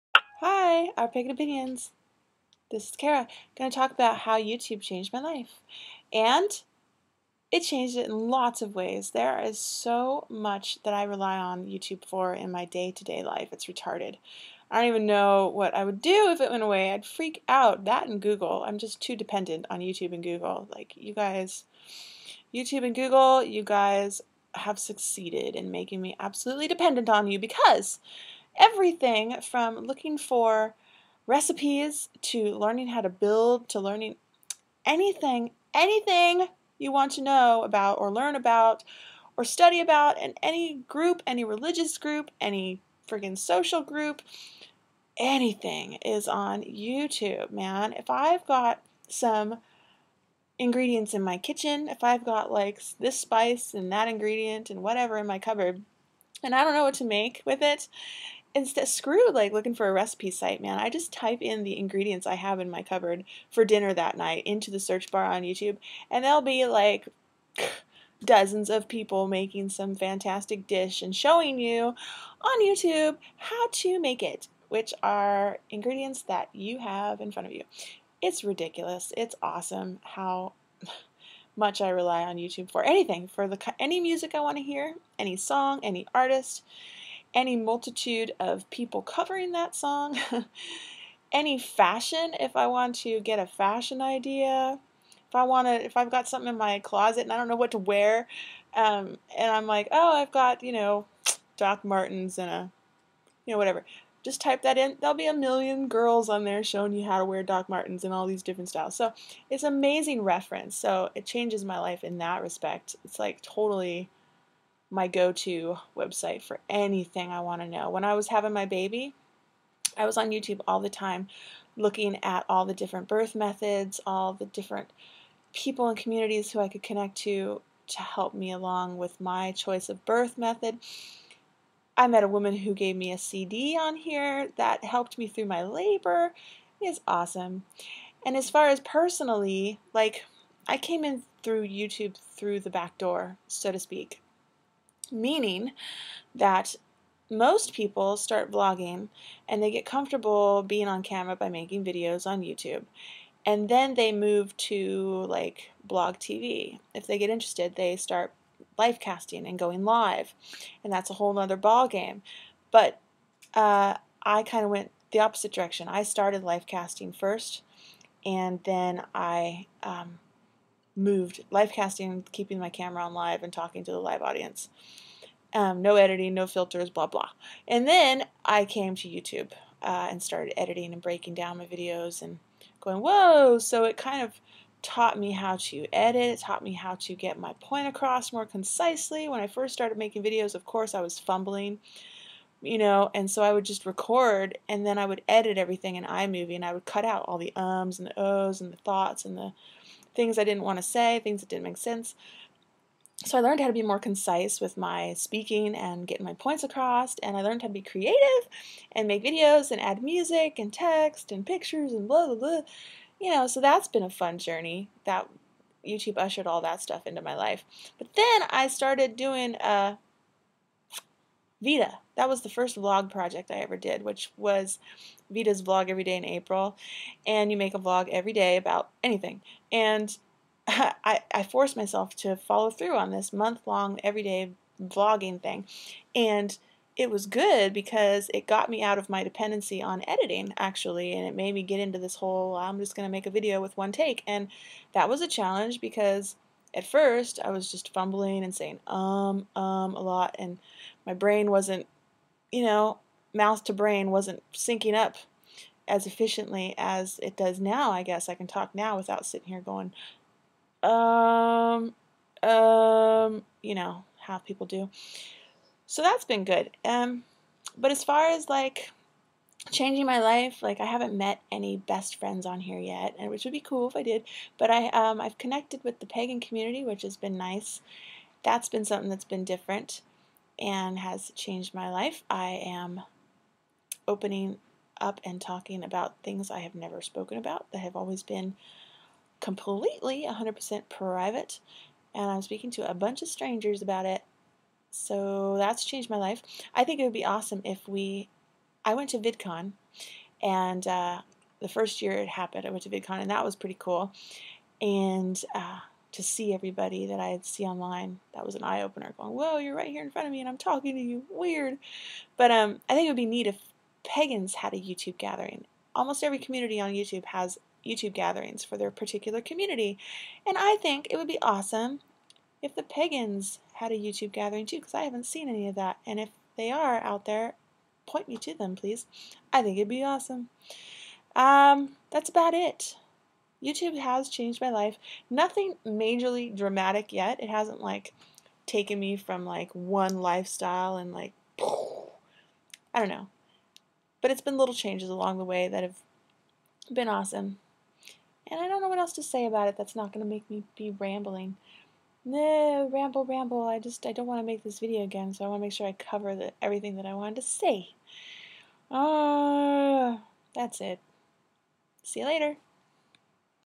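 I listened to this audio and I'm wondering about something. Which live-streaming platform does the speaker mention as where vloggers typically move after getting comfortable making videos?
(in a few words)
BlogTV.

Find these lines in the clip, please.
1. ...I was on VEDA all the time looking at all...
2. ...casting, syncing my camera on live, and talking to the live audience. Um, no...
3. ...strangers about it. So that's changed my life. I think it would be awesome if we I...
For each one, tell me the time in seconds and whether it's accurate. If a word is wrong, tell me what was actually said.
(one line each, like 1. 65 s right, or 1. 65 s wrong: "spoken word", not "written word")
1. 119 s wrong: "YouTube", not "VEDA"
2. 171 s wrong: "keeping", not "syncing"
3. 293 s right.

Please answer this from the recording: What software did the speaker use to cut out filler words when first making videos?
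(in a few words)
iMovie.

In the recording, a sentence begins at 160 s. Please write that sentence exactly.
And that's a whole other ball game.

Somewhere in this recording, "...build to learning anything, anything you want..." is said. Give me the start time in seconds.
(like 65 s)
33 s.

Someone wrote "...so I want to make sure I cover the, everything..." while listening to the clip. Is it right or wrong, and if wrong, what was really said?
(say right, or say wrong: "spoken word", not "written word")
right.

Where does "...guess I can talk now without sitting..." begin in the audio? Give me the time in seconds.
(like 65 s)
258 s.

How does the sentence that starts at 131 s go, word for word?
I met a woman who gave me a CD on here that helped me through my labor.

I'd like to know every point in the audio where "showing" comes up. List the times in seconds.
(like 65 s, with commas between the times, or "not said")
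71 s, 106 s.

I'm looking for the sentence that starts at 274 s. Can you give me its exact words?
But I um, I've connected with the pagan community, which has been nice.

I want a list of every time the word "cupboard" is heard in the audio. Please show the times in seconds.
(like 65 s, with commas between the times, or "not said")
55 s, 62 s.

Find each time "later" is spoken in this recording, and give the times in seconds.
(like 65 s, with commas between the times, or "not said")
362 s.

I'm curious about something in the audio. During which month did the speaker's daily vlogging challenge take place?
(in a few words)
April.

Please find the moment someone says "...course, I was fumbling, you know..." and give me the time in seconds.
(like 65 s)
190 s.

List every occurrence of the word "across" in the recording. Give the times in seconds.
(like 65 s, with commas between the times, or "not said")
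187 s, 206 s.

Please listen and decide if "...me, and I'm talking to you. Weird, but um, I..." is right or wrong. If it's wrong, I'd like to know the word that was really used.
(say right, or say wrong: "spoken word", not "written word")
right.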